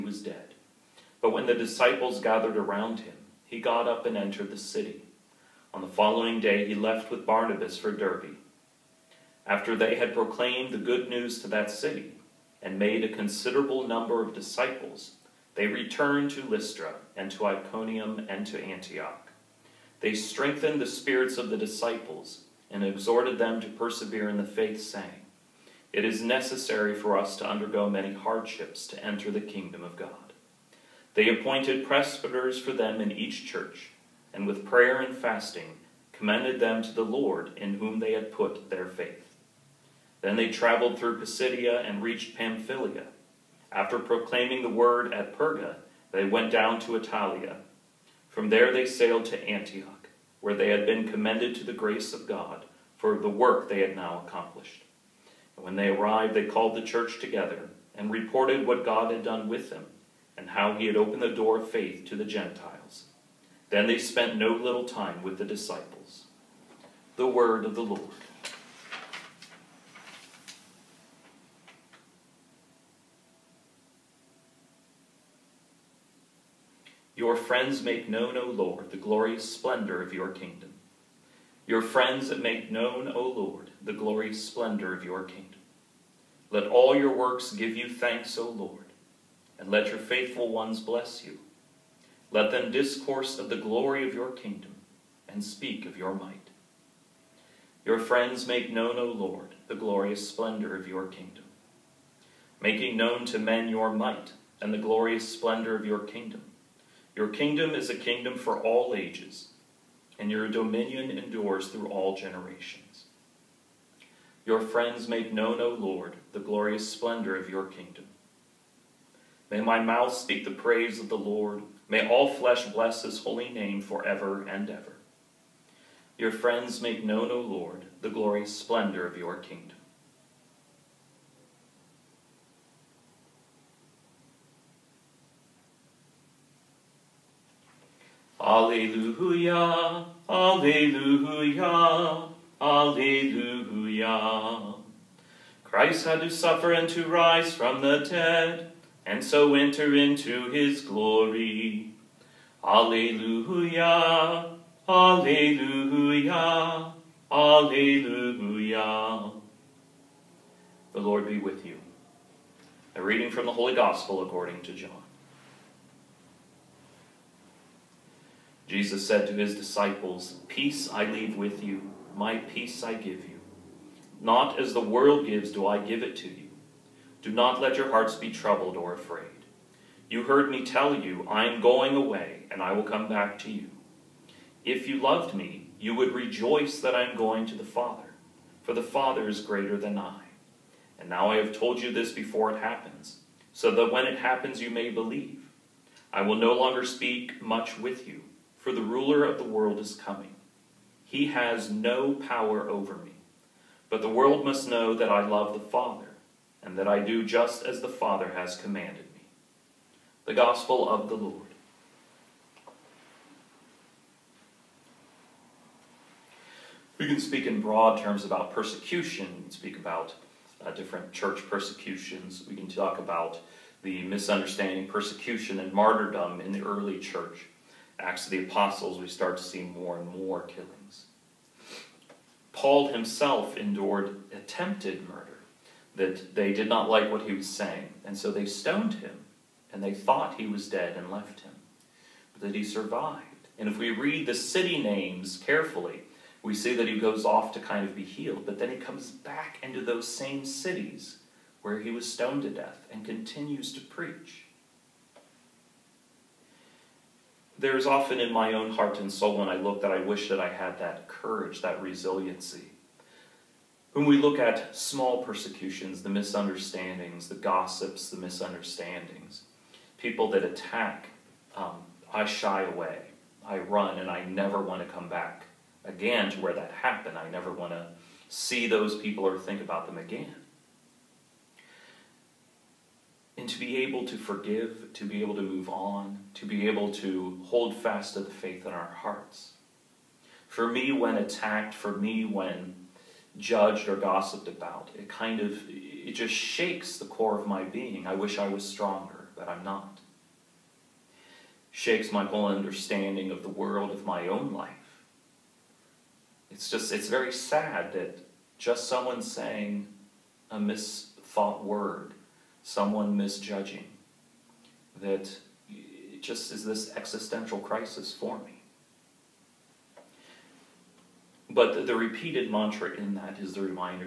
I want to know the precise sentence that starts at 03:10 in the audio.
And now I have told you this before it happens, so that when it happens you may believe.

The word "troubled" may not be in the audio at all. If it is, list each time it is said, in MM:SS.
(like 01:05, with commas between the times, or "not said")
02:58.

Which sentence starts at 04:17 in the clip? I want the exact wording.
there's often in my own heart and soul when I look that I wish that I had that courage, that resiliency.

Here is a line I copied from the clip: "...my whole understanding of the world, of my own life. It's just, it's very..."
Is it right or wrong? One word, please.
right.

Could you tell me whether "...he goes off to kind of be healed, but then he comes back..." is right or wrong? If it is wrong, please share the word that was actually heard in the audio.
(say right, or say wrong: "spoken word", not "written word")
right.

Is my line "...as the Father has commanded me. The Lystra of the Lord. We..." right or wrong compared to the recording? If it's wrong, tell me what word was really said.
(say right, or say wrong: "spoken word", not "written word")
wrong: "Gospel", not "Lystra".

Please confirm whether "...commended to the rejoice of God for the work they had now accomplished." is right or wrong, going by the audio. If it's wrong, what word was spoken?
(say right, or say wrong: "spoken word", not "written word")
wrong: "grace", not "rejoice".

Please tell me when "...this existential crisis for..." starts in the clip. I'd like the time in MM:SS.
05:16.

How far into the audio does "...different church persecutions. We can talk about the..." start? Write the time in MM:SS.
03:40.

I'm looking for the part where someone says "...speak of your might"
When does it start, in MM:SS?
01:35.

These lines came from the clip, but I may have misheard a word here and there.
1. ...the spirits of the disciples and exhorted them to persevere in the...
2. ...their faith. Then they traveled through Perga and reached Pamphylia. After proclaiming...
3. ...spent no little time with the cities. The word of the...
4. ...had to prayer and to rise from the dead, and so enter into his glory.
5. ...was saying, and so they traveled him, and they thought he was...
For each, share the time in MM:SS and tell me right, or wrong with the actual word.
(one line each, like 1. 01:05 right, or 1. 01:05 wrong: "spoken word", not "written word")
1. 00:20 right
2. 00:38 wrong: "Pisidia", not "Perga"
3. 01:03 wrong: "disciples", not "cities"
4. 02:26 wrong: "suffer", not "prayer"
5. 03:57 wrong: "stoned", not "traveled".